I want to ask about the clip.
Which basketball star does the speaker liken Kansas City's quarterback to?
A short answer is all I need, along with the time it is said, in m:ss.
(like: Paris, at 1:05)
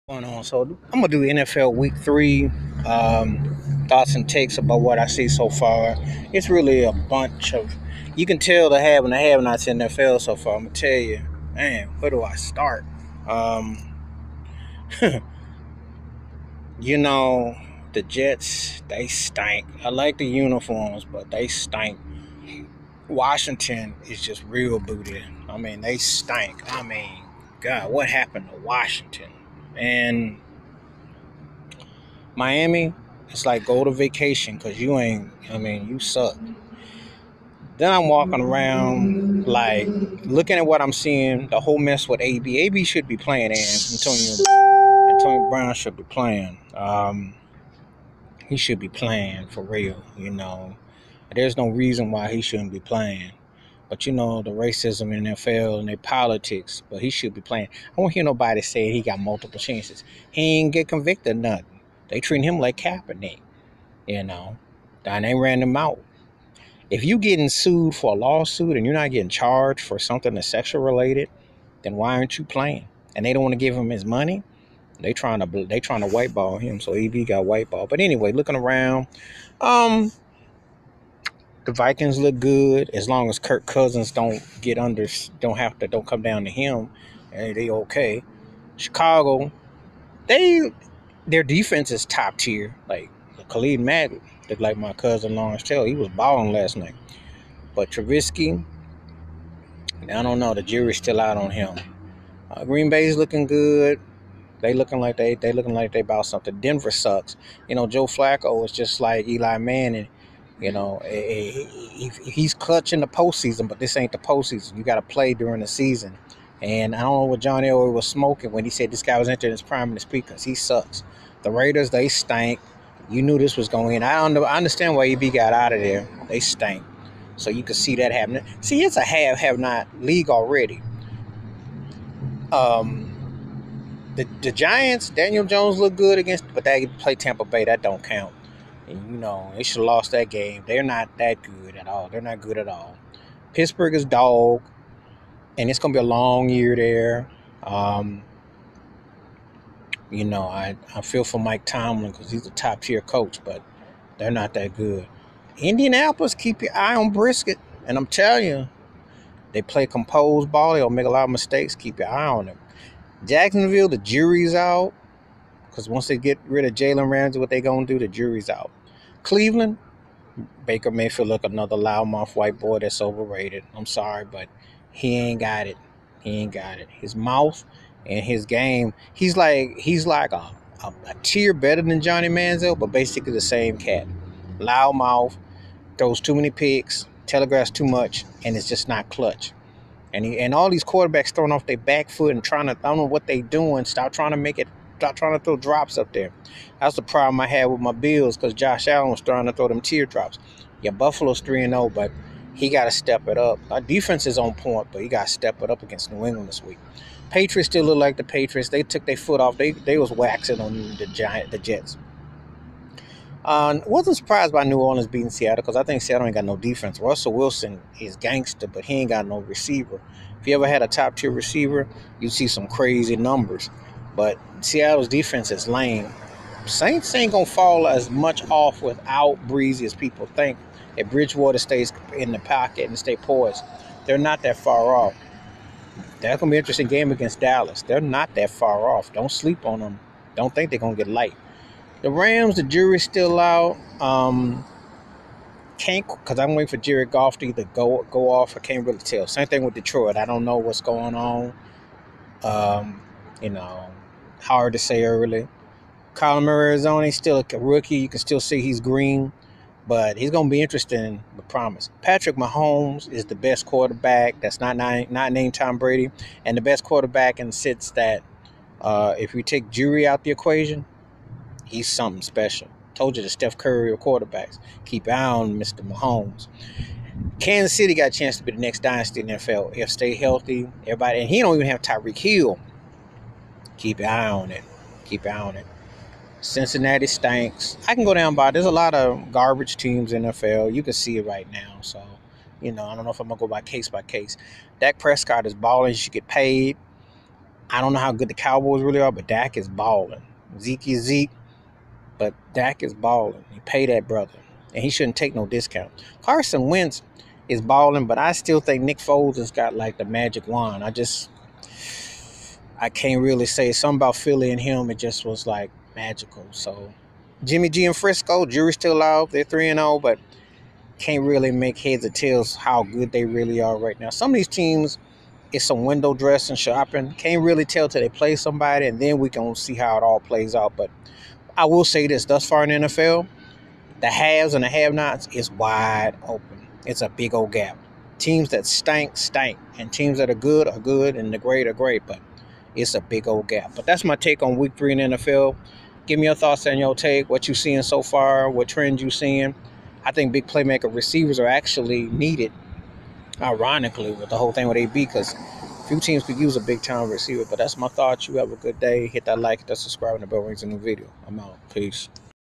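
Steph Curry, at 4:33.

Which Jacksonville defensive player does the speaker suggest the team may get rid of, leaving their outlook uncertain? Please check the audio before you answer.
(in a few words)
Jalen Ramsey.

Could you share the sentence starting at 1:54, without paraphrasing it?
You got to play during the season.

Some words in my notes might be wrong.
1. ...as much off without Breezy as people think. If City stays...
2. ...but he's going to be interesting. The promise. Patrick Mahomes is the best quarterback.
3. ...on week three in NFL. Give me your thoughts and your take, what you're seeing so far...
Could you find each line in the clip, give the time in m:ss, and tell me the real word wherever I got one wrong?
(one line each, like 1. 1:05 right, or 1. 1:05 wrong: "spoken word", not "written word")
1. 3:47 wrong: "Bridgewater", not "City"
2. 4:19 right
3. 5:44 right.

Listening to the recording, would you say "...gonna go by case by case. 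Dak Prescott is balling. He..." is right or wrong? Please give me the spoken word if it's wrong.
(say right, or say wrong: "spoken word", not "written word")
right.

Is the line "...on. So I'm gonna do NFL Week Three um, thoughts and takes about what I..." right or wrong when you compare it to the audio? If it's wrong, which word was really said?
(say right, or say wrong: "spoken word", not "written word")
right.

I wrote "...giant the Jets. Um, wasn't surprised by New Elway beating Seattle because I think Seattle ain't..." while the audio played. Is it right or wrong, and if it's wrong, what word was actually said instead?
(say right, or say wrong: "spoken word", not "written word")
wrong: "Orleans", not "Elway".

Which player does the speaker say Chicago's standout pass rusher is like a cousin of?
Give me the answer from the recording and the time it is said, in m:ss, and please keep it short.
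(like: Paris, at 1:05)
Lawrence Taylor, at 1:35.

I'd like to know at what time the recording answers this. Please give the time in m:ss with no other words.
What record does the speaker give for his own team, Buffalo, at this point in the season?
3:21.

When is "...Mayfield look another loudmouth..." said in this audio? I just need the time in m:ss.
2:50.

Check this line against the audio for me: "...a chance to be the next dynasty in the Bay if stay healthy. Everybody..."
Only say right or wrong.
wrong.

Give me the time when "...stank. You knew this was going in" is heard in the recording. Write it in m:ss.
2:02.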